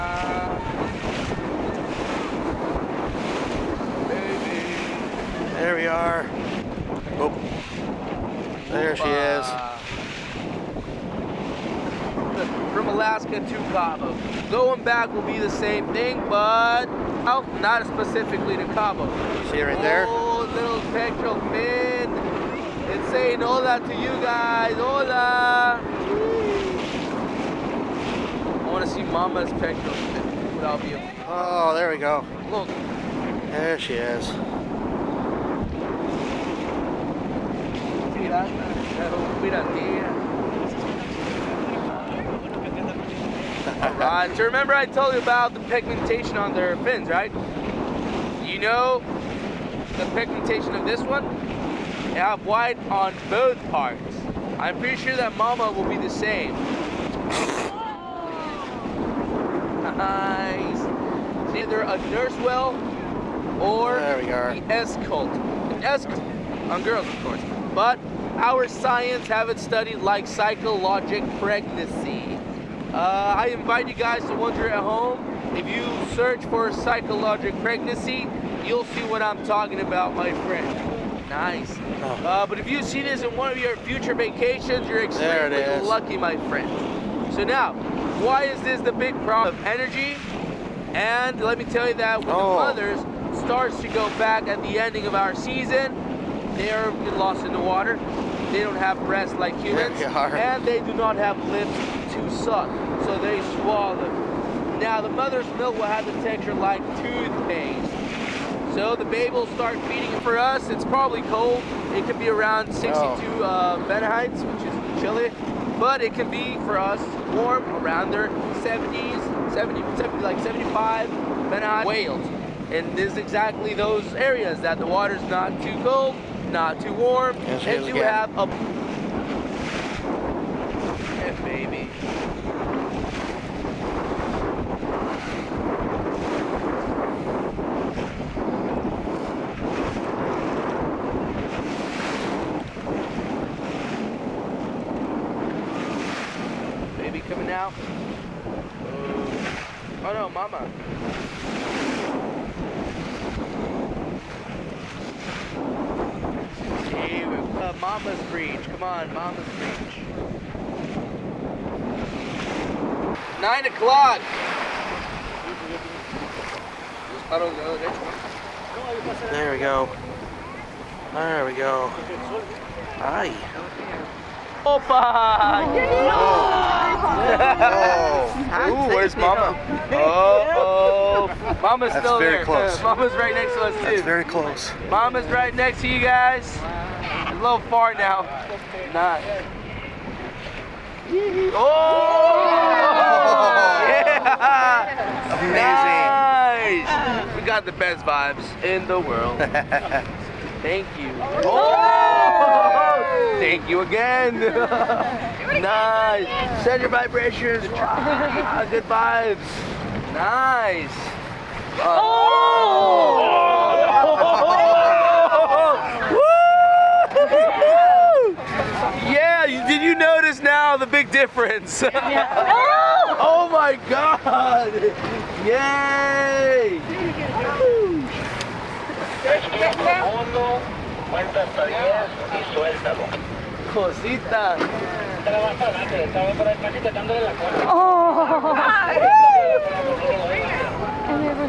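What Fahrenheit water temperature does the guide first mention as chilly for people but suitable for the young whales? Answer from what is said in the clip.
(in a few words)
62.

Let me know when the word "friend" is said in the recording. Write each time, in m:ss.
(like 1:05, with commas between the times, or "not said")
1:20, 1:26.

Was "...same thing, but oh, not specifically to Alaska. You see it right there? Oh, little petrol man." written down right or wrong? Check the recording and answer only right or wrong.
wrong.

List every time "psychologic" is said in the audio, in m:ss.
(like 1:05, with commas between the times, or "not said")
1:10, 1:16.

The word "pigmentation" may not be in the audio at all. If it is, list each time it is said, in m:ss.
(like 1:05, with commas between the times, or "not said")
0:45, 0:50.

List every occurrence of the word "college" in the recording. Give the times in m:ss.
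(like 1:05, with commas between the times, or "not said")
not said.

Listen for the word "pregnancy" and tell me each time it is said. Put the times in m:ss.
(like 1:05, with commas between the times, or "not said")
1:11, 1:17.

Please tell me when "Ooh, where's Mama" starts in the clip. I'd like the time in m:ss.
2:58.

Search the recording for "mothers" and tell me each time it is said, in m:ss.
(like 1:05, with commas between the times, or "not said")
1:32, 1:45.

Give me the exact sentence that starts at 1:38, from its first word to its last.
They don't have breasts like humans.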